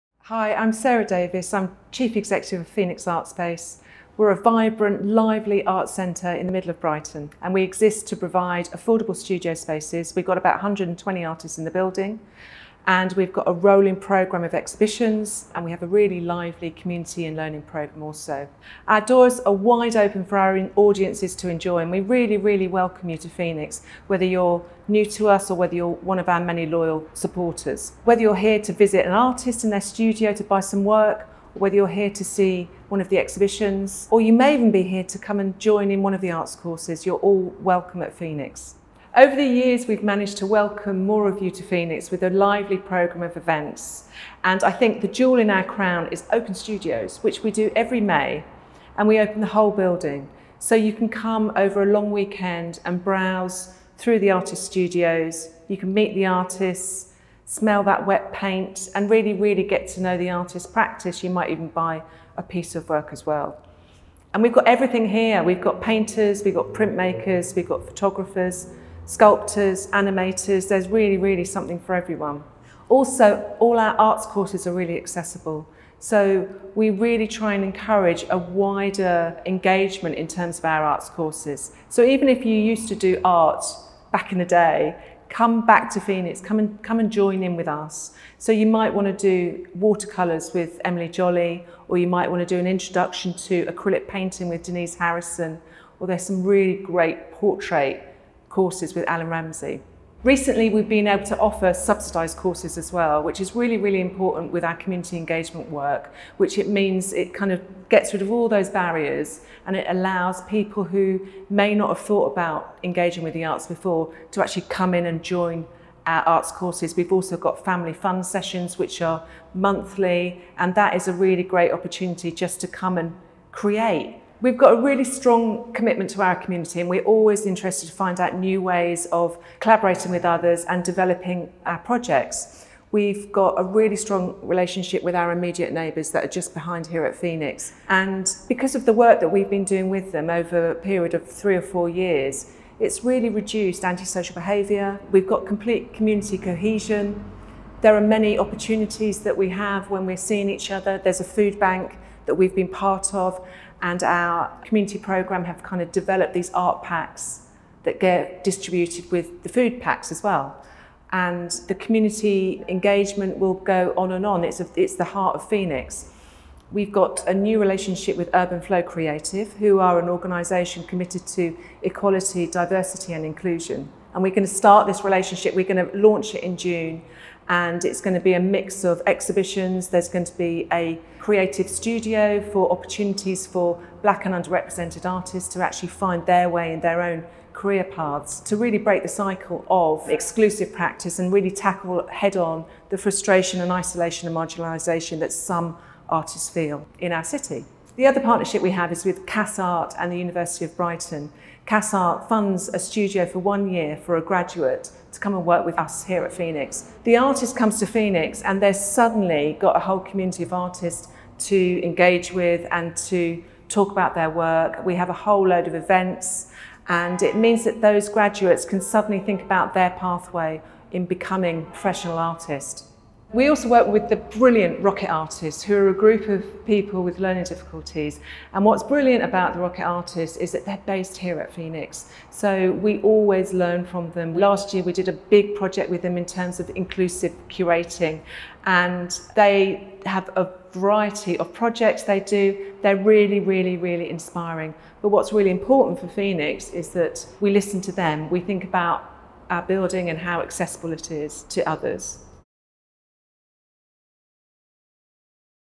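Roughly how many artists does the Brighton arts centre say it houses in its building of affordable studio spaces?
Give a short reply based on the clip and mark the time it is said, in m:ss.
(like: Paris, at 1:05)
120, at 0:10.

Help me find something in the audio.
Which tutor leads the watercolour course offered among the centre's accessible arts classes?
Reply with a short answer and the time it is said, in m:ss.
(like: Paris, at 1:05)
Emily Jolly, at 1:30.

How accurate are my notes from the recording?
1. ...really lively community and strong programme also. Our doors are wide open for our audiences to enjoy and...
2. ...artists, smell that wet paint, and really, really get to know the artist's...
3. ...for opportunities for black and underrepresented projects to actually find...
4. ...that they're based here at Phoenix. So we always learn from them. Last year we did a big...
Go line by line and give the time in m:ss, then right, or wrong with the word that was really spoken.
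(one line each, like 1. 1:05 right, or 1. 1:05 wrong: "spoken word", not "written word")
1. 0:15 wrong: "learning", not "strong"
2. 0:56 right
3. 3:02 wrong: "artists", not "projects"
4. 3:50 right.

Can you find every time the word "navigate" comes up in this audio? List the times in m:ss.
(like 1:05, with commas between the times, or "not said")
not said.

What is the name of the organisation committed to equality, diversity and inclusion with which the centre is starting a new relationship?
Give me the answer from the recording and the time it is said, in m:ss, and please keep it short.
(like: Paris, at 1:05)
Urban Flow Creative, at 2:48.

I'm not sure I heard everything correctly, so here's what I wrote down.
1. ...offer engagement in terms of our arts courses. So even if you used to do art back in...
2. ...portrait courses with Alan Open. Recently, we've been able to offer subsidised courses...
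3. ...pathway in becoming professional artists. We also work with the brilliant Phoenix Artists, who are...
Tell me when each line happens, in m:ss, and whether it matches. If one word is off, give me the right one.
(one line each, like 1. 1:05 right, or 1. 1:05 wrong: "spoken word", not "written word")
1. 1:18 wrong: "wider", not "offer"
2. 1:37 wrong: "Ramsey", not "Open"
3. 3:39 wrong: "Rocket", not "Phoenix".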